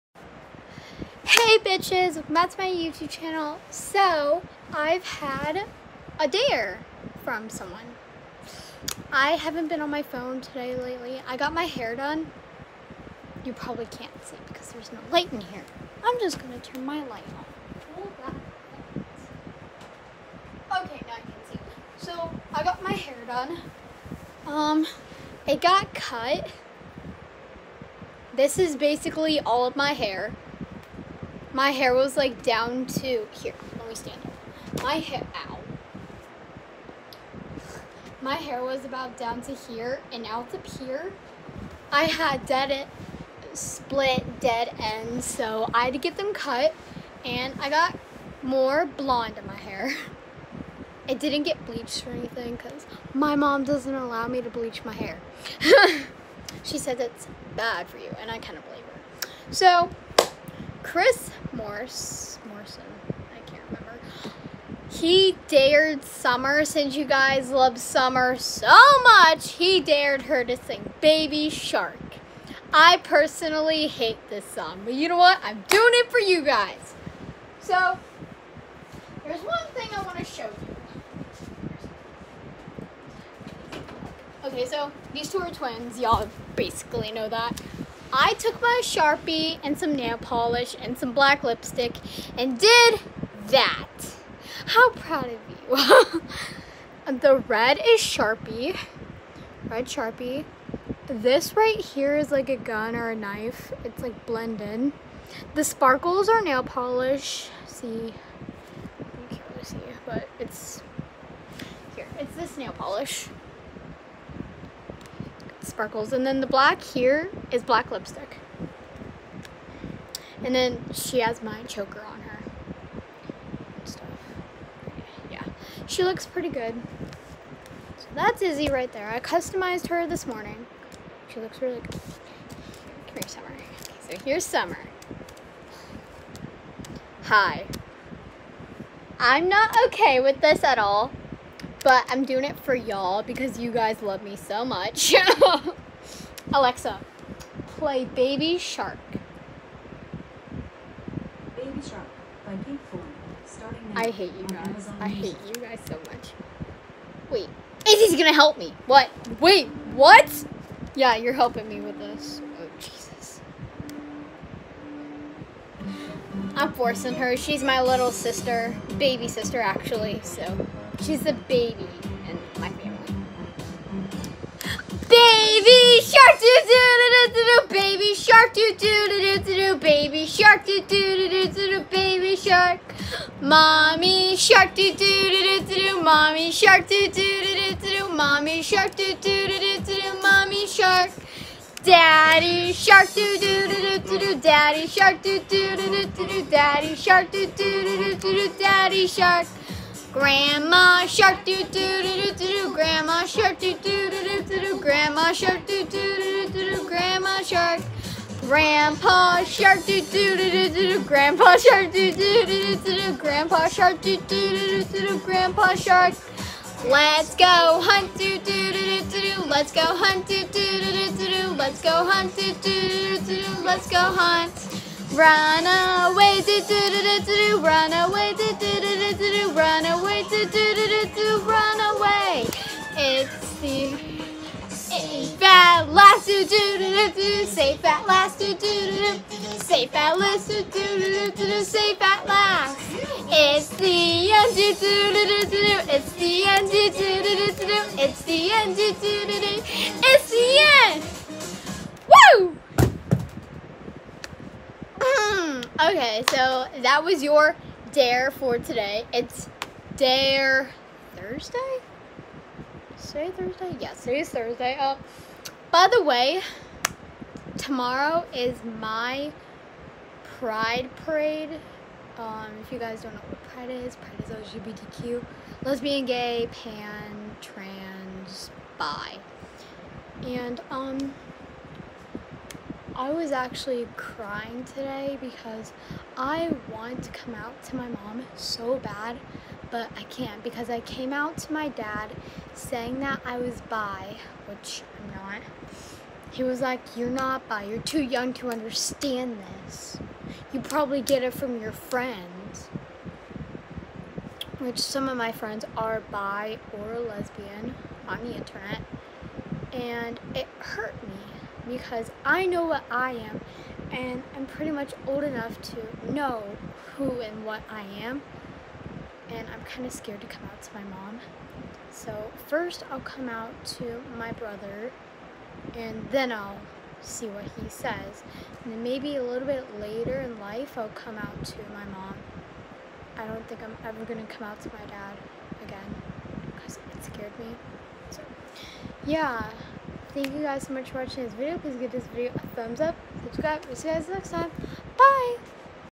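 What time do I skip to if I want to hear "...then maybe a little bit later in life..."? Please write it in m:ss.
5:28.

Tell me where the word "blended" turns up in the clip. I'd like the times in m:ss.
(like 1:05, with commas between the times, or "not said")
1:44.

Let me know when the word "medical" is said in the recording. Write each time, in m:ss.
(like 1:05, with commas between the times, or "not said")
not said.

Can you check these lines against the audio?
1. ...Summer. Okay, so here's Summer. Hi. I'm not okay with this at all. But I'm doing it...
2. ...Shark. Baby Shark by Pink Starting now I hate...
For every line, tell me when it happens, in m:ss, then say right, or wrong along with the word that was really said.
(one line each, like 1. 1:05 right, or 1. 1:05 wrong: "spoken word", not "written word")
1. 2:13 right
2. 2:28 right.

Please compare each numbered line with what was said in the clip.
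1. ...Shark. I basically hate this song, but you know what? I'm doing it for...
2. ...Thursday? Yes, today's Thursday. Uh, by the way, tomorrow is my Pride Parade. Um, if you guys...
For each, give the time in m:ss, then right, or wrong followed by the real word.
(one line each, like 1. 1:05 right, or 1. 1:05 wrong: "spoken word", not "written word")
1. 1:11 wrong: "personally", not "basically"
2. 4:23 right.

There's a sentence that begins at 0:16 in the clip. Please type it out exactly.
I'm just gonna turn my light on.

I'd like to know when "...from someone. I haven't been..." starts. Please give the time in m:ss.
0:07.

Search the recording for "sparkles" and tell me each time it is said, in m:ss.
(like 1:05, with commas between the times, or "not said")
1:45, 1:55.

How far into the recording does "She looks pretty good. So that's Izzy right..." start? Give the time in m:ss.
2:05.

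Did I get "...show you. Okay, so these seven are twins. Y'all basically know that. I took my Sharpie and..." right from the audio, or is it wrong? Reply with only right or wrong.
wrong.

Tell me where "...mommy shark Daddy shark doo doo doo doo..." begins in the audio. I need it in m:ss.
3:10.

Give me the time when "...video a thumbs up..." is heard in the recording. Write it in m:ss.
5:42.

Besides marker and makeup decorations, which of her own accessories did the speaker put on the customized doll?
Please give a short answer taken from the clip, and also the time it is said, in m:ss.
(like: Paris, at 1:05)
Choker, at 2:01.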